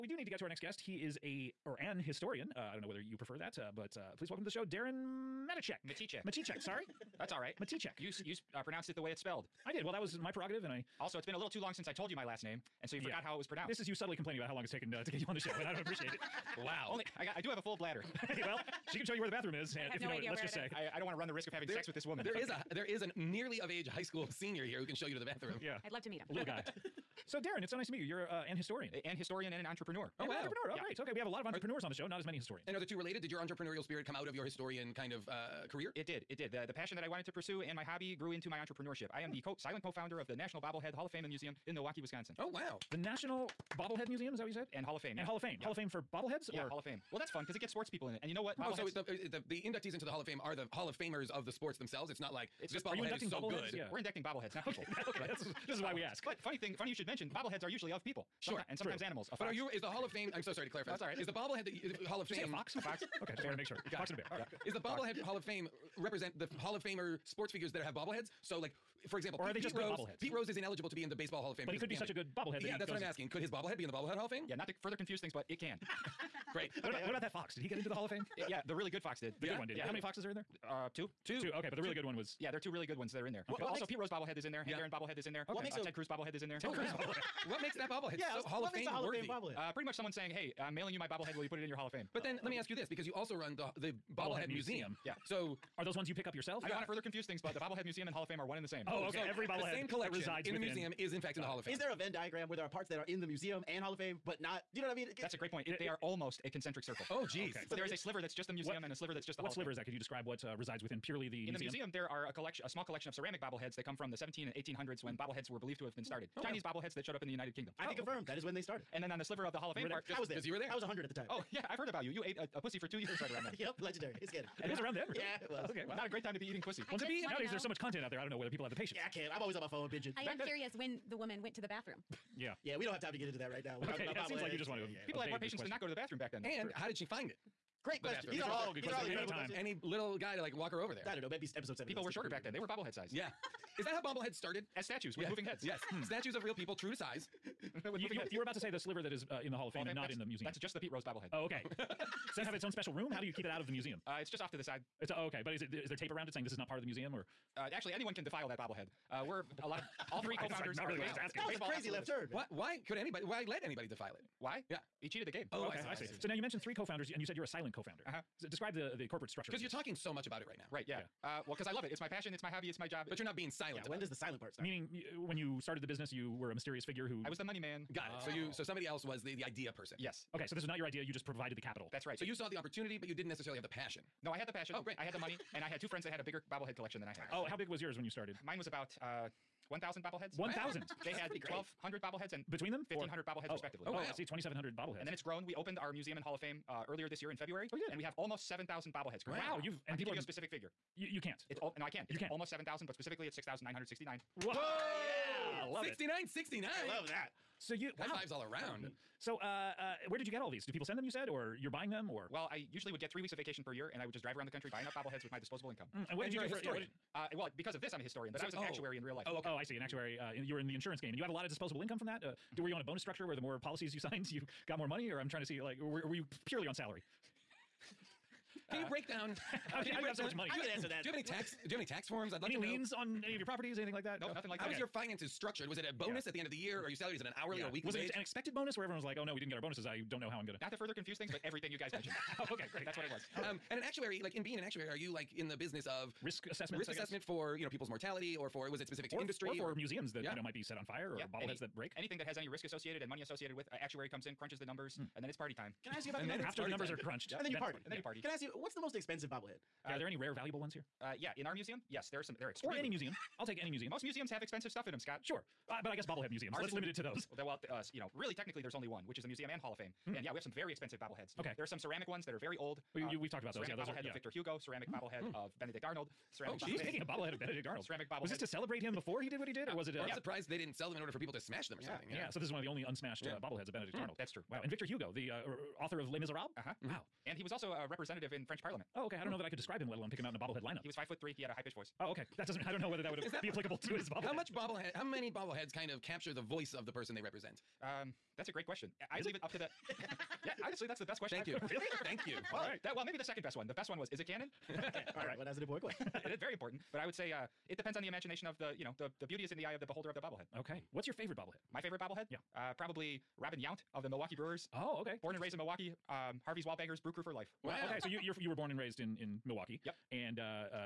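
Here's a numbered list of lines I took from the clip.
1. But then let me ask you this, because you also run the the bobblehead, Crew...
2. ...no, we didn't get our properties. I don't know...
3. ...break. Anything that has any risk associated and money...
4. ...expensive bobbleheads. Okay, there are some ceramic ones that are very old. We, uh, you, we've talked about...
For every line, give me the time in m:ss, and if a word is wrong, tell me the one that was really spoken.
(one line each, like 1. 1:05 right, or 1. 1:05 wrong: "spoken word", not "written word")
1. 1:32 wrong: "Bobblehead", not "Crew"
2. 3:59 wrong: "bonuses", not "properties"
3. 4:11 right
4. 4:30 right.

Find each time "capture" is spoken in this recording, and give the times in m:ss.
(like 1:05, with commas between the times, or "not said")
4:56.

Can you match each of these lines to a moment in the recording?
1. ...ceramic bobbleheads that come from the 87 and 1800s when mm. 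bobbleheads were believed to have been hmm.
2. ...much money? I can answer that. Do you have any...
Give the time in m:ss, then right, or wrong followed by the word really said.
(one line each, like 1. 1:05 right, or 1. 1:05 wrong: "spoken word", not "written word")
1. 1:53 wrong: "17", not "87"
2. 3:50 right.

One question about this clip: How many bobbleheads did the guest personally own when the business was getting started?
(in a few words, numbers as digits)
1,000.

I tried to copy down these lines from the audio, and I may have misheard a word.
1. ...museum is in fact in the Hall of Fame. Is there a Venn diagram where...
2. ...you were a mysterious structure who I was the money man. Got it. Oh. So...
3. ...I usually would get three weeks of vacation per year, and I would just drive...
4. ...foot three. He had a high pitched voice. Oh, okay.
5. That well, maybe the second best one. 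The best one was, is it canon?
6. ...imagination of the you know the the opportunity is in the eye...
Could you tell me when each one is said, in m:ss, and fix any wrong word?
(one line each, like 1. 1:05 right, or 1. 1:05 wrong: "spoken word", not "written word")
1. 1:40 right
2. 2:56 wrong: "figure", not "structure"
3. 3:32 right
4. 4:51 right
5. 5:02 right
6. 5:08 wrong: "beauty", not "opportunity".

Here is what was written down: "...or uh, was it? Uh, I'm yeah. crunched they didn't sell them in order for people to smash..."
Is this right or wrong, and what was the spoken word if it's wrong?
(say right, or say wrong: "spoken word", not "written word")
wrong: "surprised", not "crunched".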